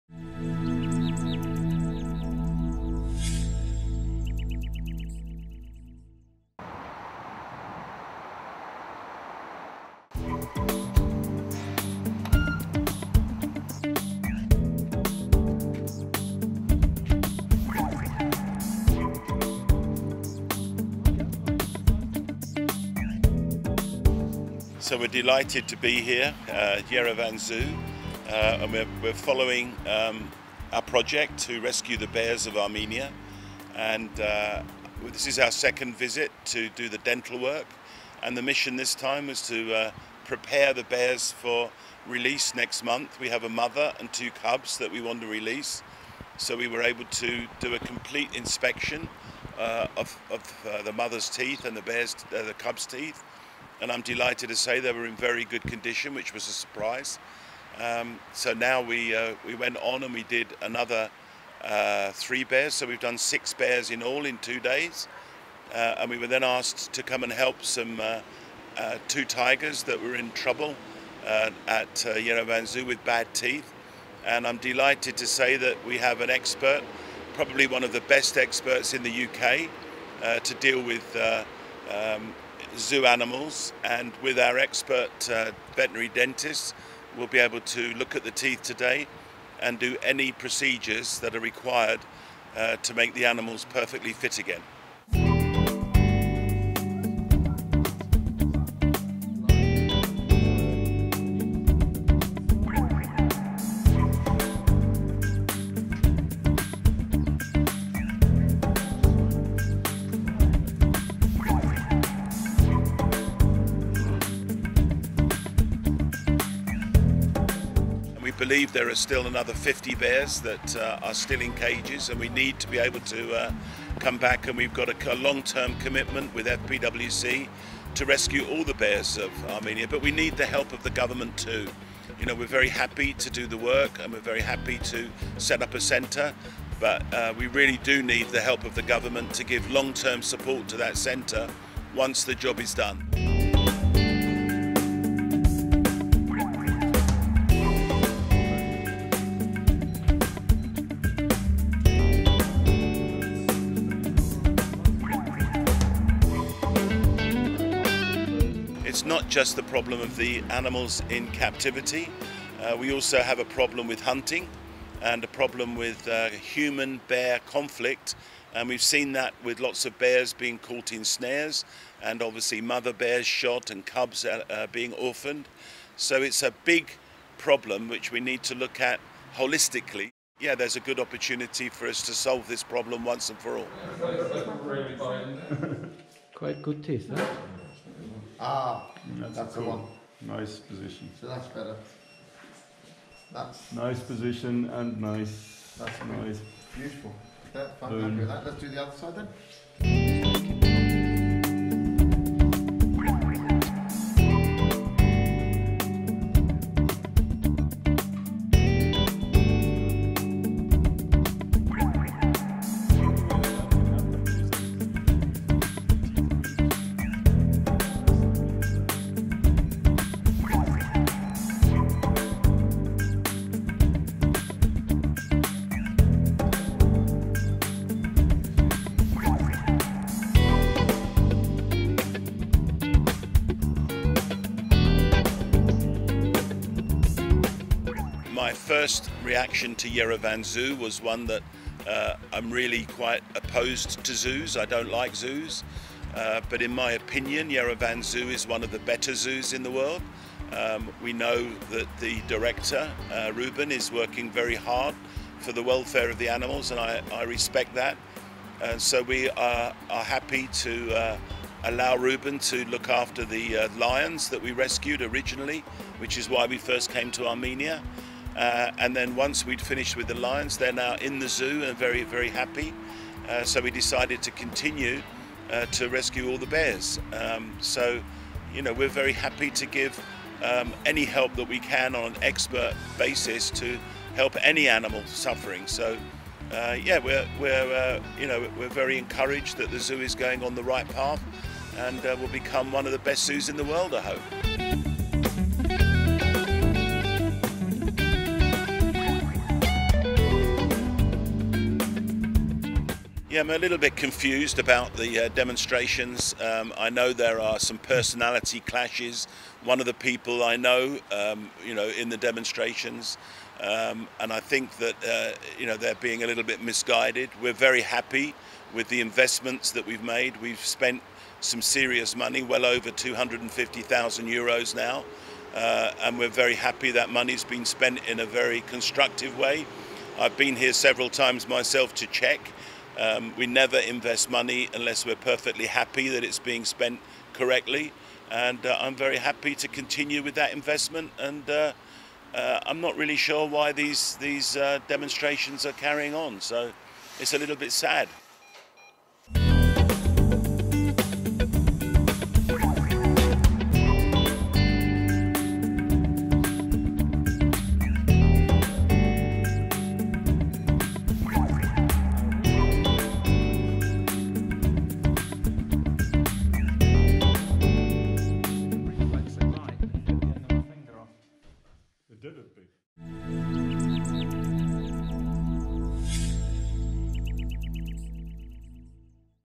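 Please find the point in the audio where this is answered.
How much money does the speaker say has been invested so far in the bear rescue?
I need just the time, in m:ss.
5:22.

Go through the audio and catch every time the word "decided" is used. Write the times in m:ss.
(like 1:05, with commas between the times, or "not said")
4:33.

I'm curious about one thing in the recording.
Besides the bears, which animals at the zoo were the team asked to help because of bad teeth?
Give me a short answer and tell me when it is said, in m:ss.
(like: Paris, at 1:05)
Tigers, at 1:09.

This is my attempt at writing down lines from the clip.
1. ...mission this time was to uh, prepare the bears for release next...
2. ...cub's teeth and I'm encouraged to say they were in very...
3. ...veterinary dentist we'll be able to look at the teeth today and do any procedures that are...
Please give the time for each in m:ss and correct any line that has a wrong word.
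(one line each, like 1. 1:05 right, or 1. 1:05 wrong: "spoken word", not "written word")
1. 0:38 right
2. 0:52 wrong: "delighted", not "encouraged"
3. 1:25 right.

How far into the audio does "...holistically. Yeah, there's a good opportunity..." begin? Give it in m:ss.
2:59.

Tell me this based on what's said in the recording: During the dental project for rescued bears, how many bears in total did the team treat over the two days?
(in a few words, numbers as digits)
6.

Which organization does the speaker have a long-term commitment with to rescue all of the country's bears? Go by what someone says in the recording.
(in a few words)
FPWC.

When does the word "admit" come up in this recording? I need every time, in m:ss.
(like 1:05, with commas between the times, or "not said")
not said.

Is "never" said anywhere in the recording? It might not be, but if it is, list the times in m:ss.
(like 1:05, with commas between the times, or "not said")
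5:33.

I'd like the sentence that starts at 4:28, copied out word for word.
Uh, and then once we'd finished with the lions, they're now in the zoo and very, very happy.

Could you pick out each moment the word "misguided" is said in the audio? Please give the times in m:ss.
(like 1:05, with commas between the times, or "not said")
5:16.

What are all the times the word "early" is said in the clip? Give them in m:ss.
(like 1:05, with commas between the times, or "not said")
not said.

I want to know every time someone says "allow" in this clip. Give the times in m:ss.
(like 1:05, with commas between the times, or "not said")
4:21.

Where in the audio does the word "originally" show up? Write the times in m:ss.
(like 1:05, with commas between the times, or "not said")
4:25.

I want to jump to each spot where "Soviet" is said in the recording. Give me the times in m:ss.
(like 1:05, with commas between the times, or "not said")
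not said.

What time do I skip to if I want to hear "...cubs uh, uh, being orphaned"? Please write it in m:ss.
2:53.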